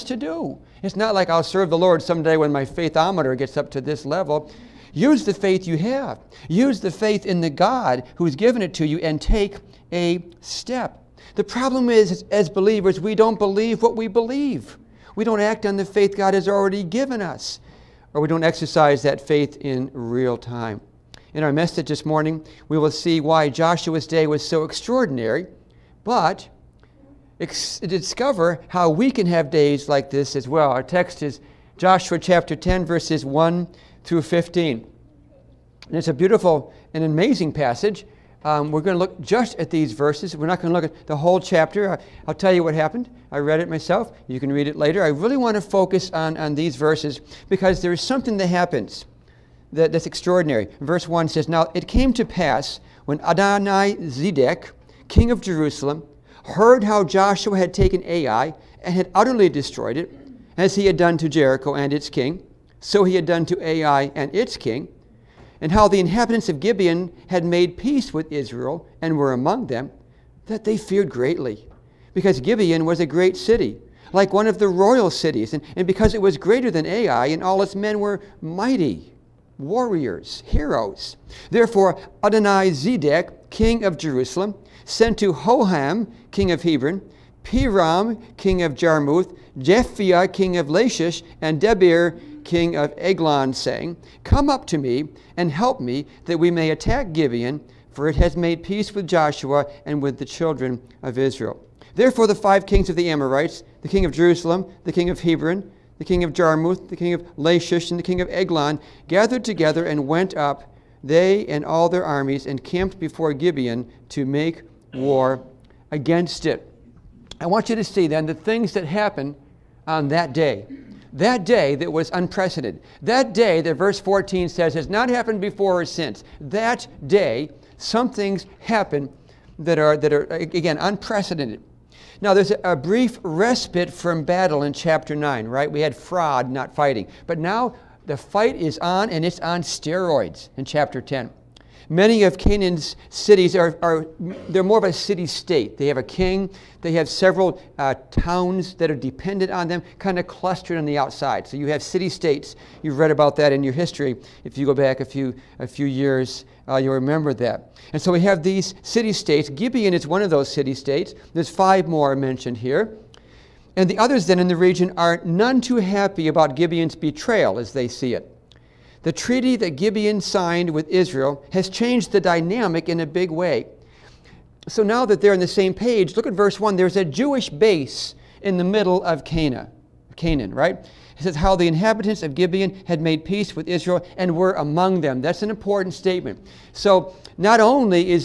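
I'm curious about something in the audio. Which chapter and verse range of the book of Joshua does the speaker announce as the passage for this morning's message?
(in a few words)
Chapter 10, verses 1-15.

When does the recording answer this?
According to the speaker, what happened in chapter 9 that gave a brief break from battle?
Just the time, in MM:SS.
02:15.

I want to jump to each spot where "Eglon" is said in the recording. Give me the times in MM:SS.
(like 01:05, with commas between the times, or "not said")
01:32, 01:48.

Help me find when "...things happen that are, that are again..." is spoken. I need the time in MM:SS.
02:08.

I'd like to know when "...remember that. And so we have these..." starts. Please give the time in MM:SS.
02:36.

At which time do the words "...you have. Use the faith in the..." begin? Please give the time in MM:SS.
00:05.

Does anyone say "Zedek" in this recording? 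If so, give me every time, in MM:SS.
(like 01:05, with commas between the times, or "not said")
00:53, 01:22.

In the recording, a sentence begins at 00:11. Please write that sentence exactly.
The problem is, as believers, we don't believe what we believe.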